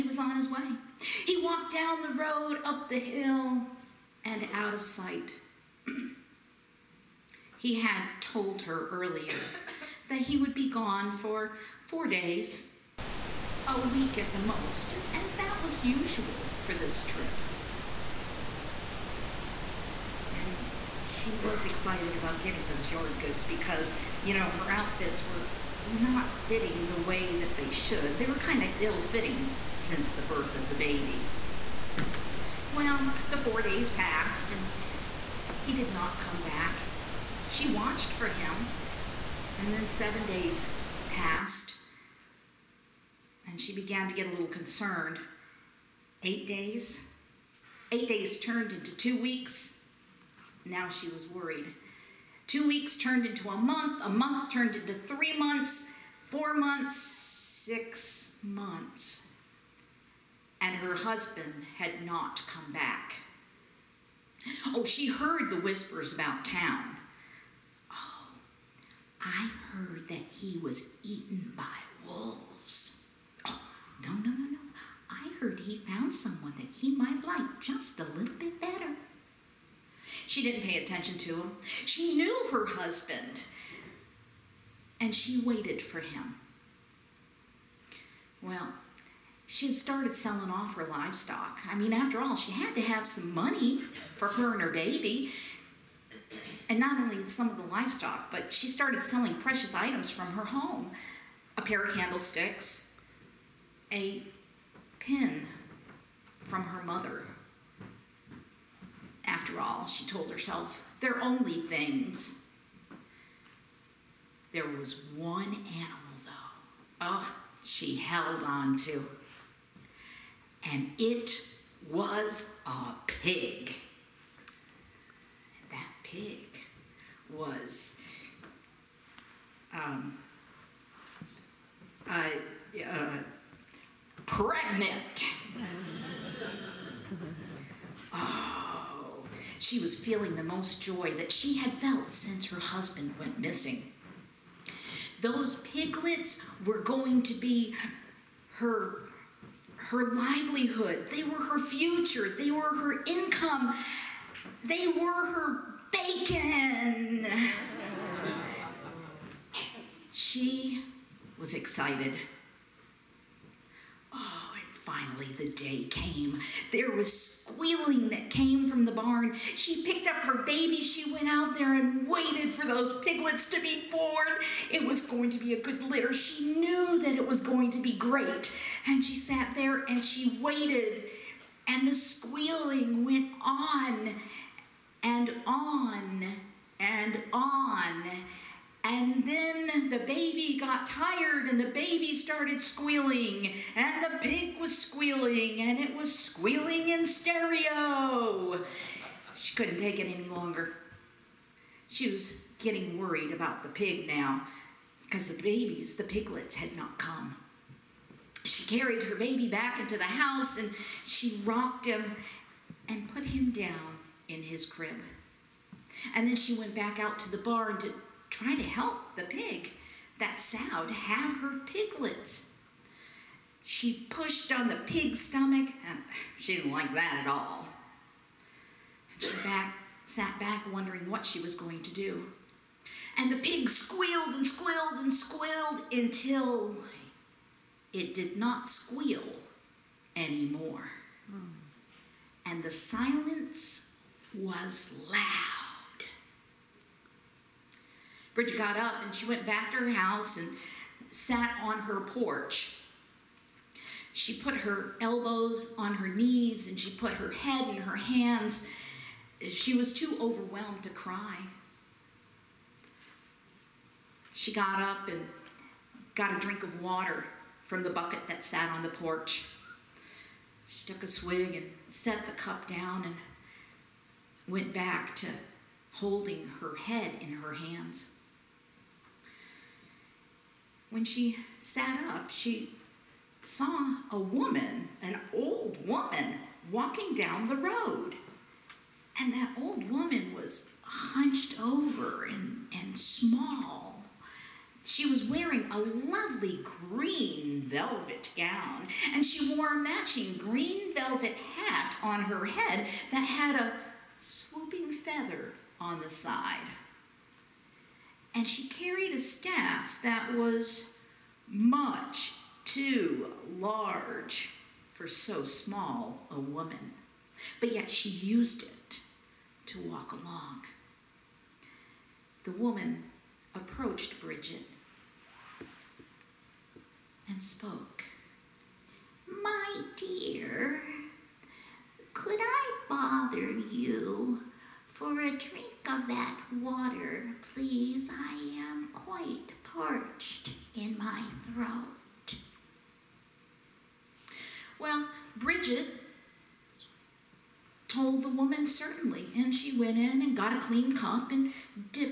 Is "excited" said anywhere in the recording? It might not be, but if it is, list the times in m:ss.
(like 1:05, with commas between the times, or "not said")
0:21, 2:41.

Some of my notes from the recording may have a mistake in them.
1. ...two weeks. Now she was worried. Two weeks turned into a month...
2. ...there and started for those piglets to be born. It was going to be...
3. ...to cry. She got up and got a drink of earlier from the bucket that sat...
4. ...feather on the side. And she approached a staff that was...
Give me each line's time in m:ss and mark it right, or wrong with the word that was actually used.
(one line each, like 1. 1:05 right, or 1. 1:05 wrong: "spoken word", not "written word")
1. 0:48 right
2. 2:51 wrong: "waited", not "started"
3. 4:20 wrong: "water", not "earlier"
4. 5:04 wrong: "carried", not "approached".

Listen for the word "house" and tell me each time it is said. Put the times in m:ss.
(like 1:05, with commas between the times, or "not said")
3:30, 4:09.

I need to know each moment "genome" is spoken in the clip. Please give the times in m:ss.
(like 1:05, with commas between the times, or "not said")
not said.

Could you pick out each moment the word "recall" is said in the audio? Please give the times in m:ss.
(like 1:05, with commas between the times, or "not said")
not said.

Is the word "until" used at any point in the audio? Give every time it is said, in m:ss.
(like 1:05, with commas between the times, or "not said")
3:55.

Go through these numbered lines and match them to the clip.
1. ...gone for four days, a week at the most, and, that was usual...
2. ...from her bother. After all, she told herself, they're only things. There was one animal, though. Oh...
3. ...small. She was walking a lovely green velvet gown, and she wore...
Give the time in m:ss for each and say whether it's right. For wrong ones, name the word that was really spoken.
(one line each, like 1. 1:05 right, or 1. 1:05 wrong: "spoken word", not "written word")
1. 0:10 right
2. 1:46 wrong: "mother", not "bother"
3. 4:52 wrong: "wearing", not "walking".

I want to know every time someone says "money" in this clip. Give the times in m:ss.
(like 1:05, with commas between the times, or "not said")
1:33.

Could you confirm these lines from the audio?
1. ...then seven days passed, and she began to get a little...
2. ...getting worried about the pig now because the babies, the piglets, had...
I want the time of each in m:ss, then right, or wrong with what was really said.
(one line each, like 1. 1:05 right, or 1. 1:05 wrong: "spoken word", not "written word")
1. 0:39 right
2. 3:22 right.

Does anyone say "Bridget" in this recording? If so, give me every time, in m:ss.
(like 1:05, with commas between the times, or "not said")
4:08, 5:24, 5:45.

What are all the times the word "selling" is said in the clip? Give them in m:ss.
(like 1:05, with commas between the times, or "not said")
1:30, 1:39.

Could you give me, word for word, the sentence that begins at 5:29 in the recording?
My dear, could I bother you for a drink of that water, please?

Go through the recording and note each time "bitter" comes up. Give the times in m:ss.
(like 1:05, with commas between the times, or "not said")
not said.